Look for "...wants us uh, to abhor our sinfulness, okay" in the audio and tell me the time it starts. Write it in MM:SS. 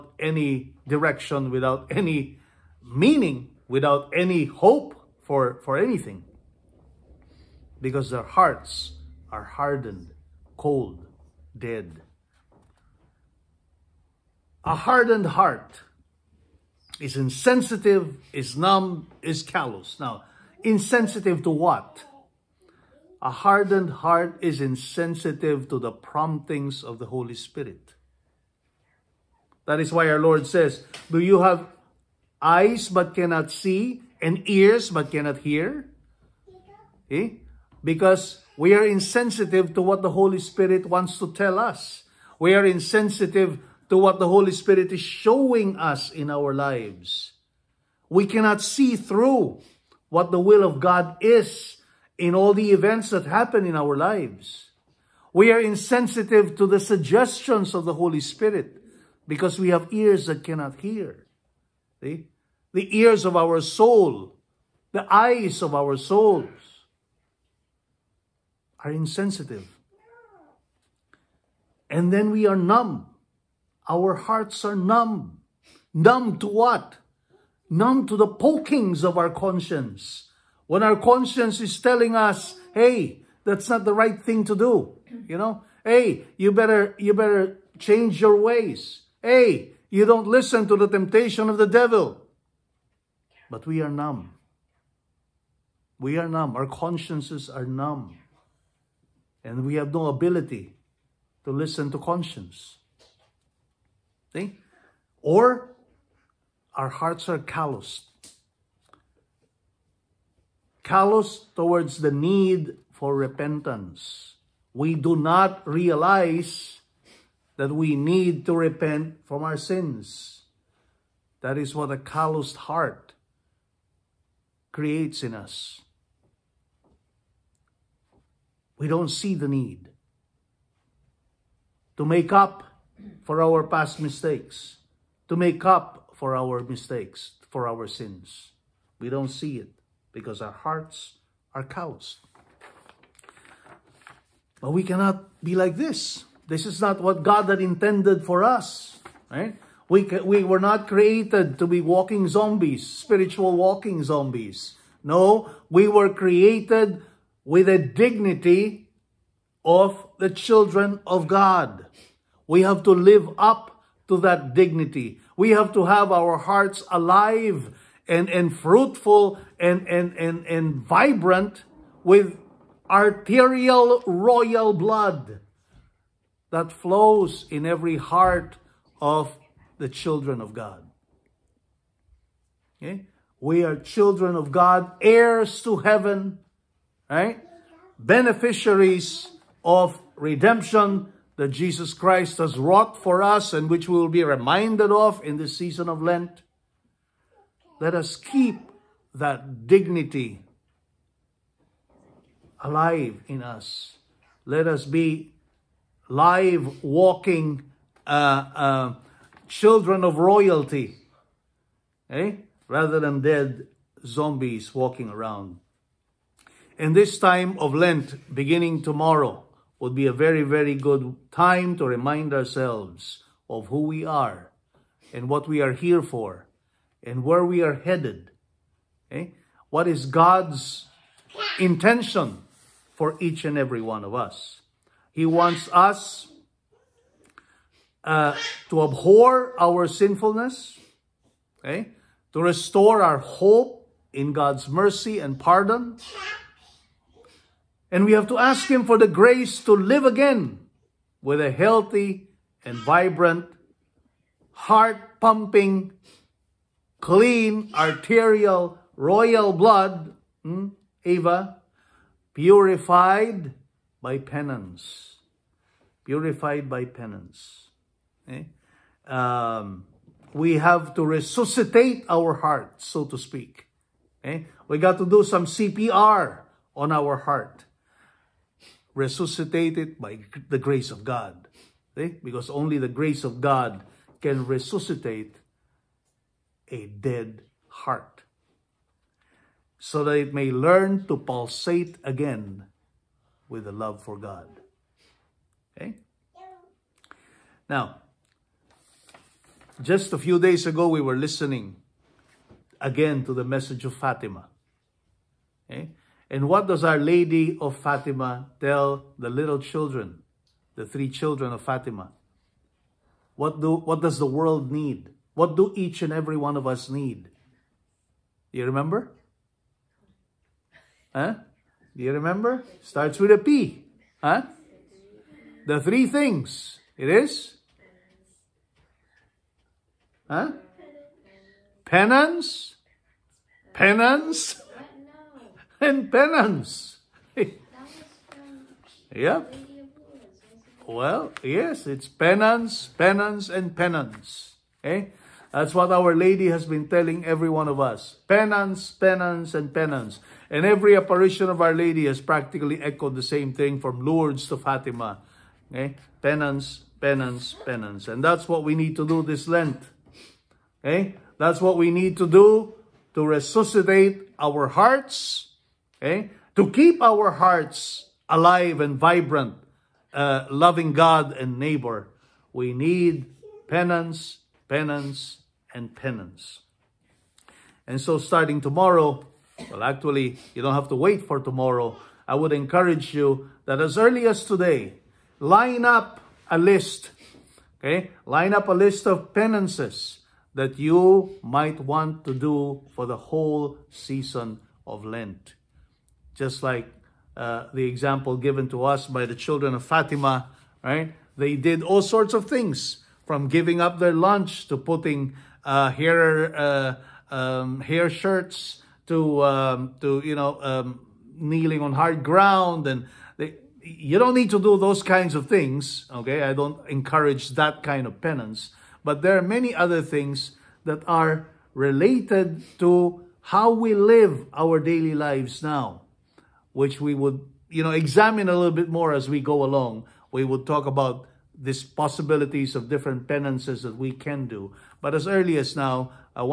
03:55.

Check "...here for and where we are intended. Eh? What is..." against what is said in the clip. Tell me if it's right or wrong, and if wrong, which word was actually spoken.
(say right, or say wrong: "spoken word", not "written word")
wrong: "headed", not "intended".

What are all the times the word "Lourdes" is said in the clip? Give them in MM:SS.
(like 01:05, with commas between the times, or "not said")
05:54.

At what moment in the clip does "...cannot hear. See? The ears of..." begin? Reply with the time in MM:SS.
01:00.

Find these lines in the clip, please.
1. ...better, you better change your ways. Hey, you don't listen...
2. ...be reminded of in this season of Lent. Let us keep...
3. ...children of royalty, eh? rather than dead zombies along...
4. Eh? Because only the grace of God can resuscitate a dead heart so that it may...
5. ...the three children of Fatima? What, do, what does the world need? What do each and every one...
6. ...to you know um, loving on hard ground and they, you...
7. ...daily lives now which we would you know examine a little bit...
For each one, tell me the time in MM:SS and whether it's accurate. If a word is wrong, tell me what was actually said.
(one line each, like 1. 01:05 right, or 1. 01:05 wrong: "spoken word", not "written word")
1. 01:26 right
2. 03:14 right
3. 03:29 wrong: "walking", not "along"
4. 04:42 right
5. 05:10 right
6. 06:50 wrong: "kneeling", not "loving"
7. 07:04 right.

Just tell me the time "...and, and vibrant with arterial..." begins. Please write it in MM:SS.
02:50.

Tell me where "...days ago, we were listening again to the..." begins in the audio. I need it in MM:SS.
05:00.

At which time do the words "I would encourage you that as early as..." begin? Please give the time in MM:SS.
06:22.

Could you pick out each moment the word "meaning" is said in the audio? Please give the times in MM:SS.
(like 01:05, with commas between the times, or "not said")
00:02.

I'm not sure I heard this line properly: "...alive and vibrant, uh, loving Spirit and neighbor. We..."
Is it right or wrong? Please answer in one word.
wrong.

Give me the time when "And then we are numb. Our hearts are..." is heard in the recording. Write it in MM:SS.
01:11.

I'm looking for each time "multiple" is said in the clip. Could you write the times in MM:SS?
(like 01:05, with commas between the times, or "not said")
not said.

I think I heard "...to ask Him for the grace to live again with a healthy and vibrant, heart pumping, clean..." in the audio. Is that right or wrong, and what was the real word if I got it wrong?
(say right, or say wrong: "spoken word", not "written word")
right.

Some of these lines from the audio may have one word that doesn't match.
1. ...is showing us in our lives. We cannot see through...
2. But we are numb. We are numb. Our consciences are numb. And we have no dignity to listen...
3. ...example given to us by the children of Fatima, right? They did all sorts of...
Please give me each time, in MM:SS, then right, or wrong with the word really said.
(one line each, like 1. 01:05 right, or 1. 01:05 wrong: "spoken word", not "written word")
1. 00:44 right
2. 01:33 wrong: "ability", not "dignity"
3. 06:37 right.